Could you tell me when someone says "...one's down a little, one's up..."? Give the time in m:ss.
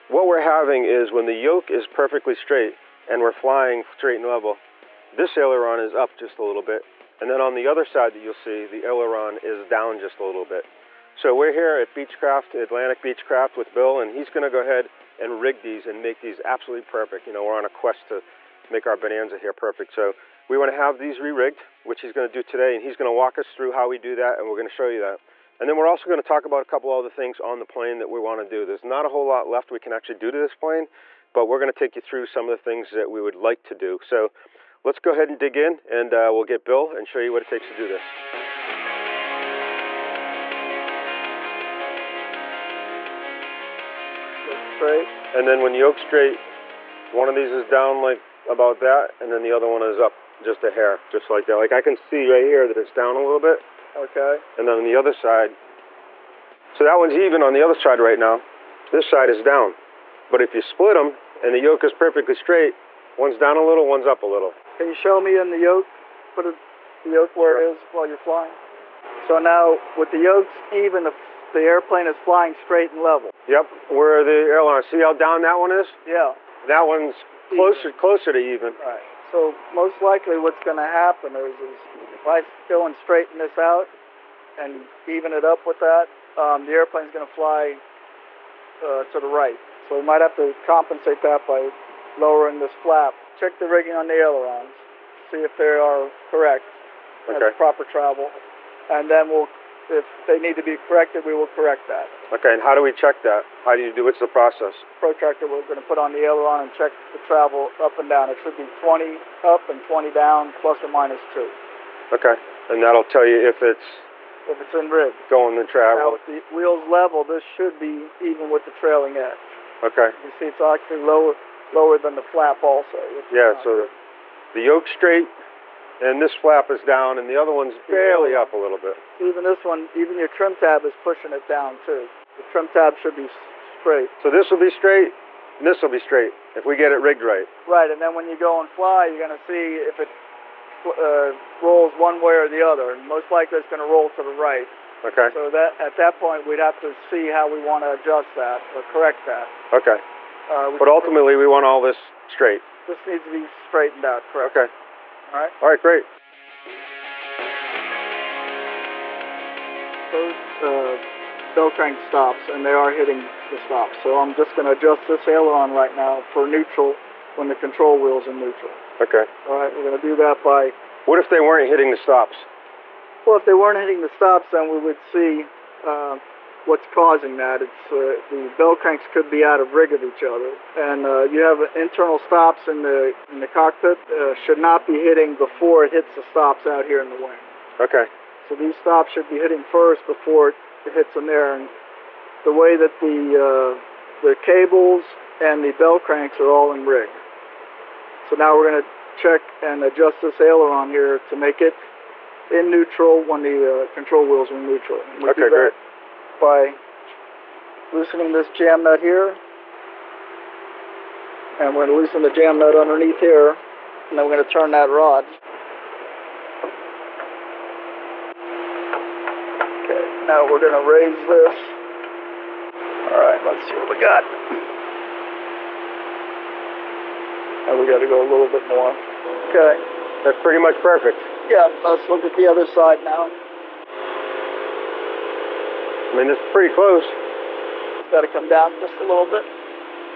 1:03.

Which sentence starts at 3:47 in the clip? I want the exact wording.
And we got to go a little bit more.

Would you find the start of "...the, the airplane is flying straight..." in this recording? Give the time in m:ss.
1:11.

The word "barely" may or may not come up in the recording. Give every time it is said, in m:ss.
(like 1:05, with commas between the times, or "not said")
2:07.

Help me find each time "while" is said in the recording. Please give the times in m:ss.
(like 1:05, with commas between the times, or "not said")
1:07.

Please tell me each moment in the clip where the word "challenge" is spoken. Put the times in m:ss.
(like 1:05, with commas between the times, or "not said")
not said.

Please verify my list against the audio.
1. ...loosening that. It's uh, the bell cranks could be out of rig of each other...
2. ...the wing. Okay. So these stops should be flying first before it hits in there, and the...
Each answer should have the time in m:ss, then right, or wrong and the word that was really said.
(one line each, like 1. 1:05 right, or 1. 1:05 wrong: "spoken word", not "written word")
1. 2:56 wrong: "causing", not "loosening"
2. 3:07 wrong: "hitting", not "flying".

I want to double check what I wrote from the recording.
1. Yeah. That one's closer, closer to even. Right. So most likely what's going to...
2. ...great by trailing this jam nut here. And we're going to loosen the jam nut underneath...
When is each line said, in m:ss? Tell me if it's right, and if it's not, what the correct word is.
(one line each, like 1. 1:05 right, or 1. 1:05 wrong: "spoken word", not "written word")
1. 1:16 right
2. 3:25 wrong: "loosening", not "trailing".